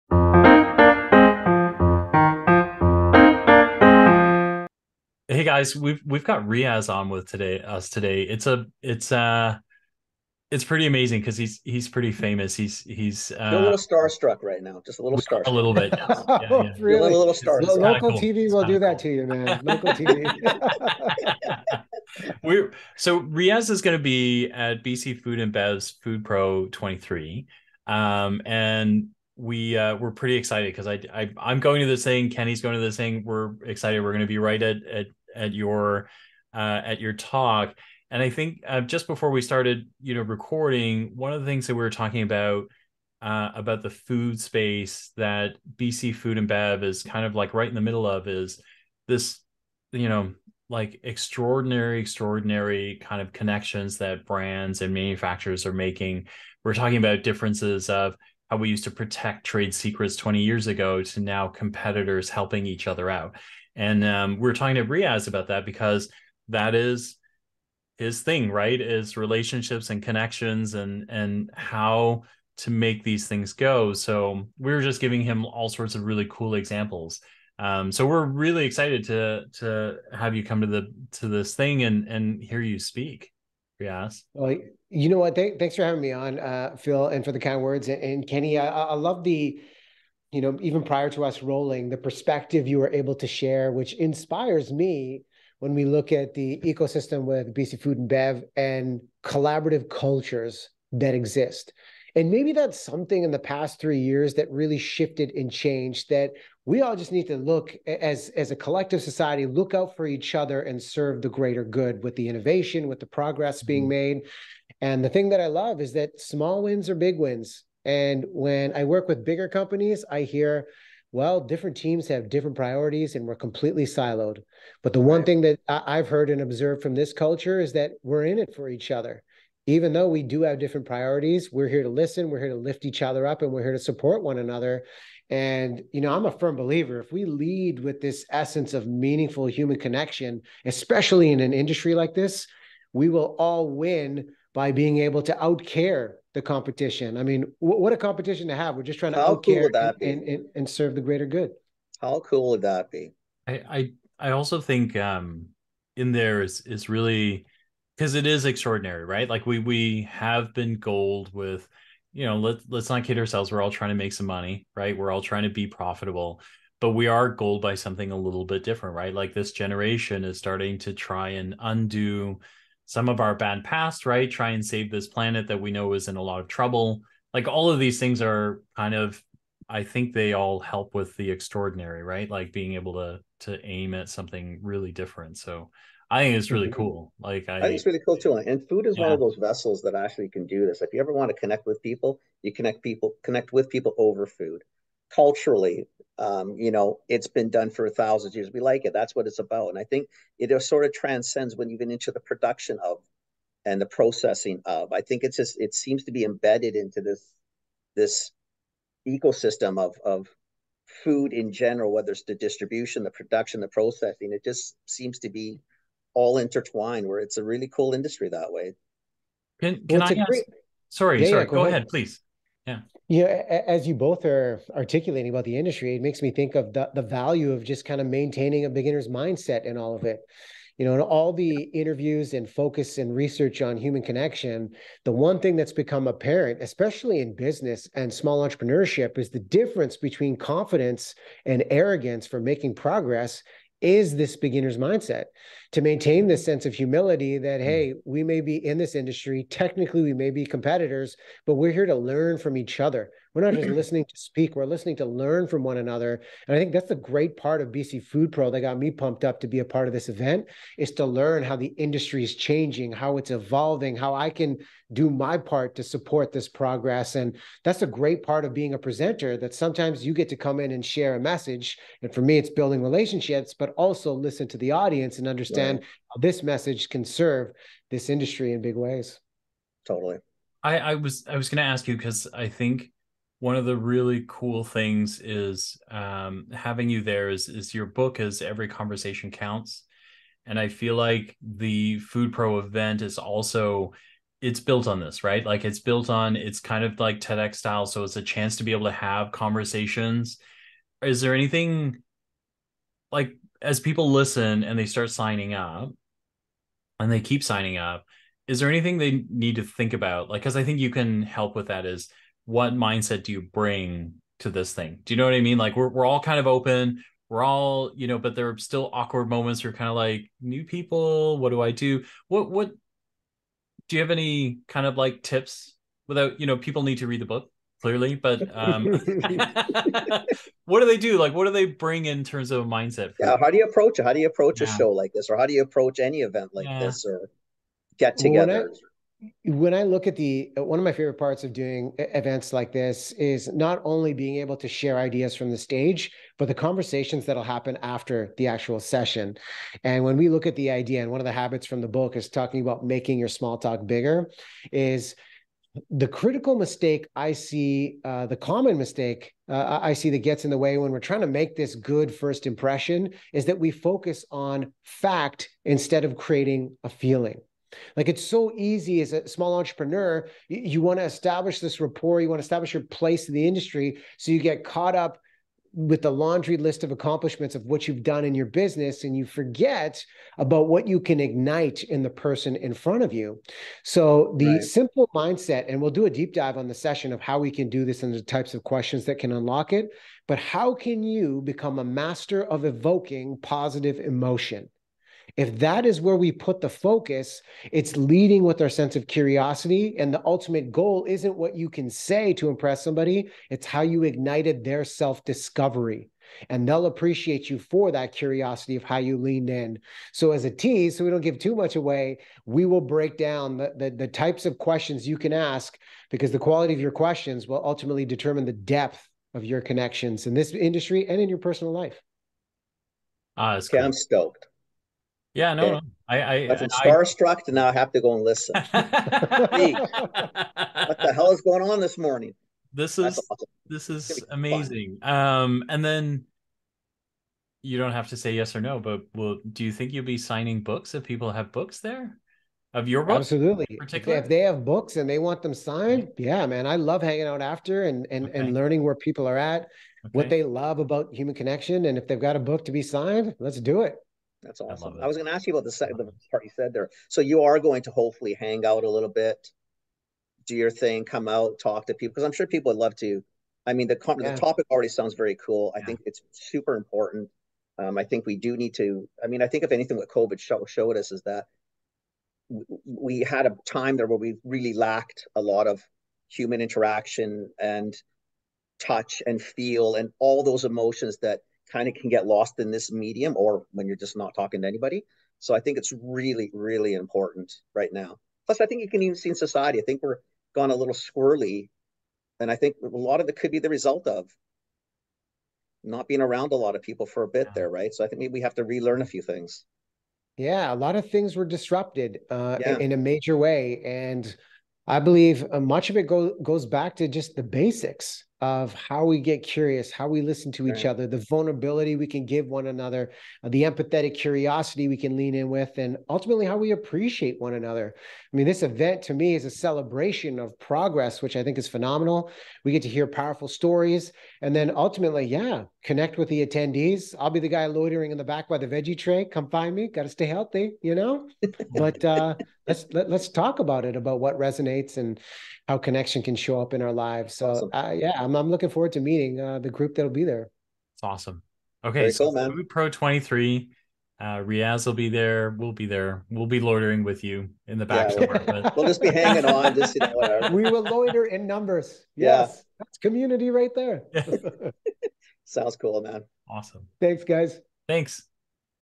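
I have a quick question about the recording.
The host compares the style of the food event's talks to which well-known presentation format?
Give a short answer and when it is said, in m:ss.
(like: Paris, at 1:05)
TEDx, at 4:57.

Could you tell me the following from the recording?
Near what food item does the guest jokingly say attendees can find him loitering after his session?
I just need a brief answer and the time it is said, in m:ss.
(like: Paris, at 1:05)
The veggie tray, at 8:48.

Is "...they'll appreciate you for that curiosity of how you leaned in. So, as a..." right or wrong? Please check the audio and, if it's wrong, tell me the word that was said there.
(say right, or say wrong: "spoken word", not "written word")
right.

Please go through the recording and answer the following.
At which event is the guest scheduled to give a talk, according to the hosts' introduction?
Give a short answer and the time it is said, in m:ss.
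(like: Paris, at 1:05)
Food Pro 23, at 0:25.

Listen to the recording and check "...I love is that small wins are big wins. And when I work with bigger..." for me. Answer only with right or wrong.
right.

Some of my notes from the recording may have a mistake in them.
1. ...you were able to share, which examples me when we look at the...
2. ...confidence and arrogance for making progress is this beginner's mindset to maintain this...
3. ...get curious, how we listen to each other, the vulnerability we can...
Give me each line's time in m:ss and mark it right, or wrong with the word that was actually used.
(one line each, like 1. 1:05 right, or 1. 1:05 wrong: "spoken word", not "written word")
1. 1:32 wrong: "inspires", not "examples"
2. 4:00 right
3. 8:29 right.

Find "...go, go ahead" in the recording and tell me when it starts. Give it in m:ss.
3:41.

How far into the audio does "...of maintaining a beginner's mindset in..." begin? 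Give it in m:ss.
3:48.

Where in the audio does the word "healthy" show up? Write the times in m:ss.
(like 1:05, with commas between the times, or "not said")
8:50.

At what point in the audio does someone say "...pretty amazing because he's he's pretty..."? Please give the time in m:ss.
0:10.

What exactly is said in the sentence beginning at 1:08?
Is relationships and connections and and how to make these things go.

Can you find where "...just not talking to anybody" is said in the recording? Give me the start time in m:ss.
8:03.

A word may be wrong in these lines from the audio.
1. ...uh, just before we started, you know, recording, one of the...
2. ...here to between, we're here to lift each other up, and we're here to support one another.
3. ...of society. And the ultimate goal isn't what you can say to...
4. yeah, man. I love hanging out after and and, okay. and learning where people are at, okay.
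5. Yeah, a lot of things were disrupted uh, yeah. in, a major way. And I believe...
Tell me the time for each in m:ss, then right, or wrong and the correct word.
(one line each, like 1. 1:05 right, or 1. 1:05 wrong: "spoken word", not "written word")
1. 0:38 right
2. 2:11 wrong: "listen", not "between"
3. 6:38 wrong: "curiosity", not "society"
4. 7:26 right
5. 8:20 right.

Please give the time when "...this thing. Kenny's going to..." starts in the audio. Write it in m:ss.
0:31.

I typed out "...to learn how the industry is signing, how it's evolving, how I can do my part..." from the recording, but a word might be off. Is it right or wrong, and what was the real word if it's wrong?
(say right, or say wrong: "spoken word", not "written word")
wrong: "changing", not "signing".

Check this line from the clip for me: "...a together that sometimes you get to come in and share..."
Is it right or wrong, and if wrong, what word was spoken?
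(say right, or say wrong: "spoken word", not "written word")
wrong: "presenter", not "together".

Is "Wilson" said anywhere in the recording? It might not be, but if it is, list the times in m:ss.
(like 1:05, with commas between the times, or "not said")
not said.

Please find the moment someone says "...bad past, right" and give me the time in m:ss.
2:53.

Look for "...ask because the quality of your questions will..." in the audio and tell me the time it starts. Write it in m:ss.
6:55.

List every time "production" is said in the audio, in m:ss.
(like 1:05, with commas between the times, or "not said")
3:22, 3:33.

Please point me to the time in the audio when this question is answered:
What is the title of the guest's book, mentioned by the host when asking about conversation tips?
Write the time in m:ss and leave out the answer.
4:48.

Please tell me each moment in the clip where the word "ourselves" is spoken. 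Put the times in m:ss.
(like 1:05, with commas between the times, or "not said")
2:43.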